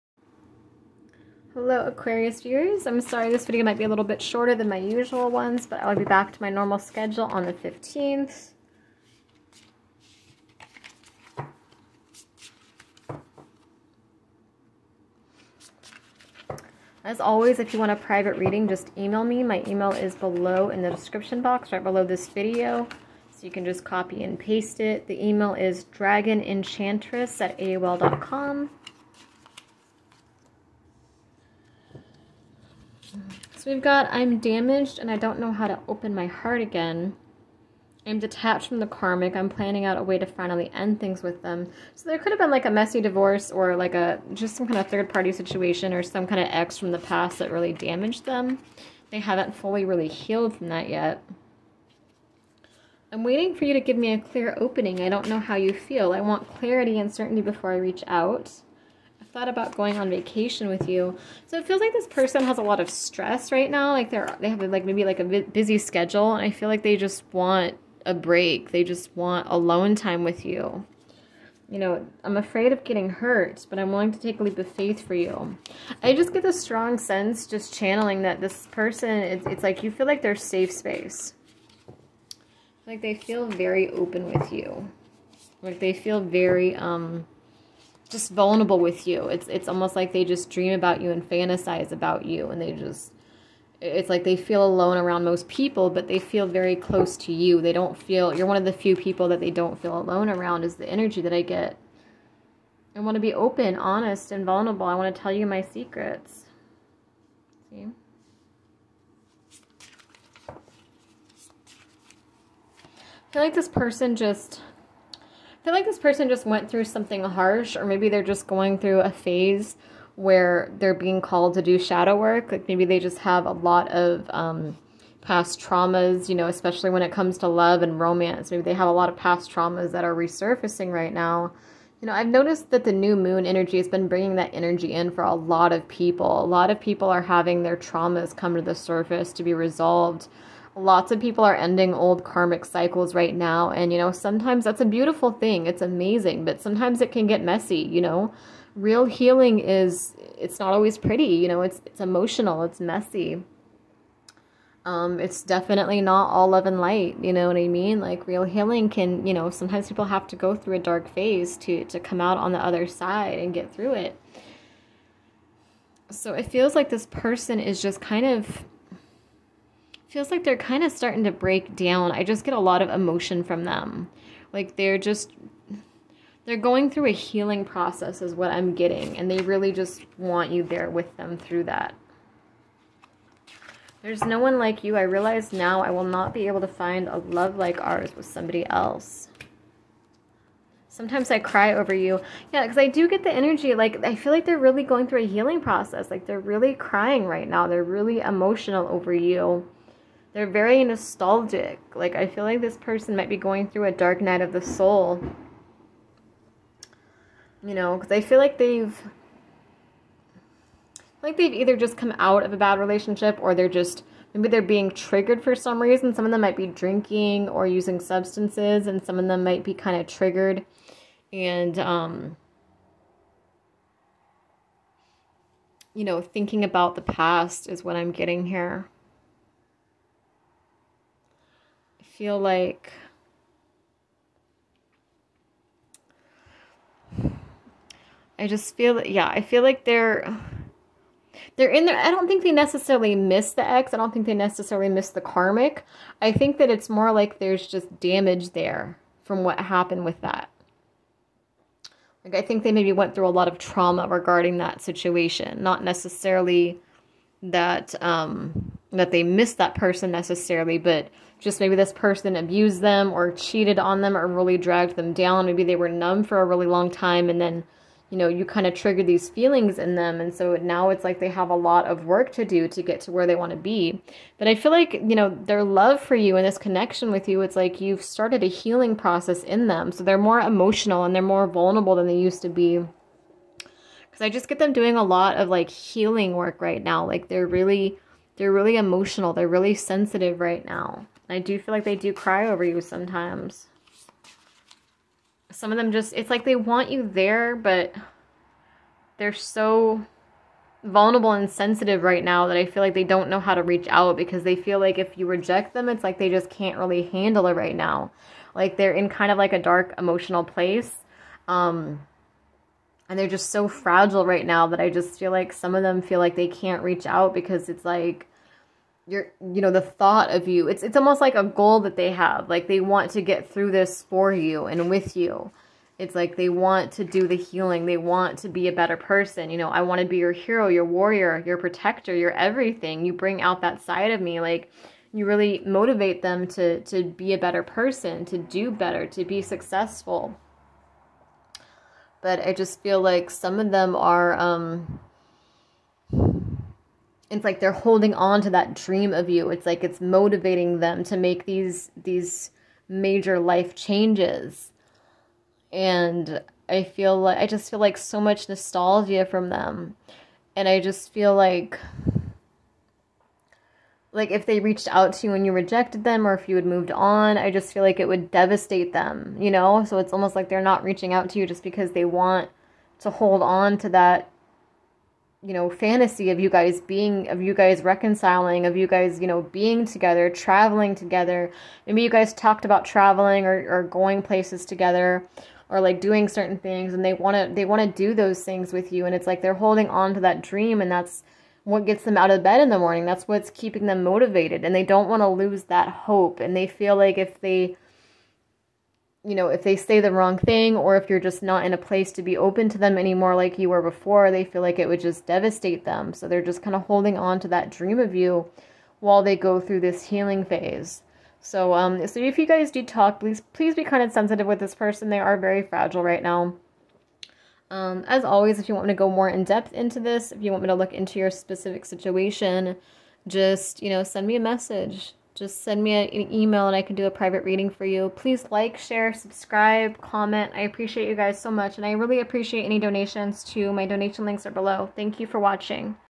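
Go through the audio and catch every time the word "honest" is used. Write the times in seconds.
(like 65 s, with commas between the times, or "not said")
103 s.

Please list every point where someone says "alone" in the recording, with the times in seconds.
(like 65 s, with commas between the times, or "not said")
69 s, 94 s, 99 s.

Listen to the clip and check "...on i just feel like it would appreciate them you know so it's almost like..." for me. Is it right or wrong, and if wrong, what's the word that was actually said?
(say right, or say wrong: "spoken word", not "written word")
wrong: "devastate", not "appreciate".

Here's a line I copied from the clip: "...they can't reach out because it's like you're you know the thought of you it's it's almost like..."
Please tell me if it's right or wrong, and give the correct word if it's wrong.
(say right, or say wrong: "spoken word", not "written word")
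right.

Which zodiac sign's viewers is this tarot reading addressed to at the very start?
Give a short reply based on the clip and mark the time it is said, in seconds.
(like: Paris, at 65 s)
Aquarius, at 1 s.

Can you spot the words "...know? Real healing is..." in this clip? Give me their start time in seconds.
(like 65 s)
148 s.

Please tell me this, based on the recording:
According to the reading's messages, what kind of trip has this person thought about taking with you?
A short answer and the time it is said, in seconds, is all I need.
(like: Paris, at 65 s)
vacation, at 60 s.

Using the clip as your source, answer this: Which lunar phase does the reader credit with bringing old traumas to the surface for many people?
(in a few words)
new moon.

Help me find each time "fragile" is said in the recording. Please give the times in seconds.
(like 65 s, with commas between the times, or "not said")
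313 s, 415 s.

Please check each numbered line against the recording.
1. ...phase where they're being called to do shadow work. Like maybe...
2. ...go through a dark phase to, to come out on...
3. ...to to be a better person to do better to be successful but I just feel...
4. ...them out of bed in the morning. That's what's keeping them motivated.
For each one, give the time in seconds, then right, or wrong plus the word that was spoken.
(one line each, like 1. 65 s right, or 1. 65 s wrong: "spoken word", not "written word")
1. 119 s right
2. 160 s right
3. 336 s right
4. 392 s right.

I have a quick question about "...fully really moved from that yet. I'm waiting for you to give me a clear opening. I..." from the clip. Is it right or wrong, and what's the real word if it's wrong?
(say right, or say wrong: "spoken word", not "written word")
wrong: "healed", not "moved".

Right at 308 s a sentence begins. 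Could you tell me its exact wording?
Like they're in kind of like a dark emotional place.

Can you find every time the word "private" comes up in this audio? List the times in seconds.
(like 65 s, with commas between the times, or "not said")
17 s, 427 s.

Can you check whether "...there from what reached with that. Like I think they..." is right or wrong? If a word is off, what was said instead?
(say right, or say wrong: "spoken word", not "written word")
wrong: "happened", not "reached".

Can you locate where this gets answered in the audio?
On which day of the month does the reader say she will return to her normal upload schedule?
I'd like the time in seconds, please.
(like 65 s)
7 s.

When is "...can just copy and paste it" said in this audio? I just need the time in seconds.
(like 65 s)
23 s.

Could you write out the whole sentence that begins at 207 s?
You know, because I feel like they've.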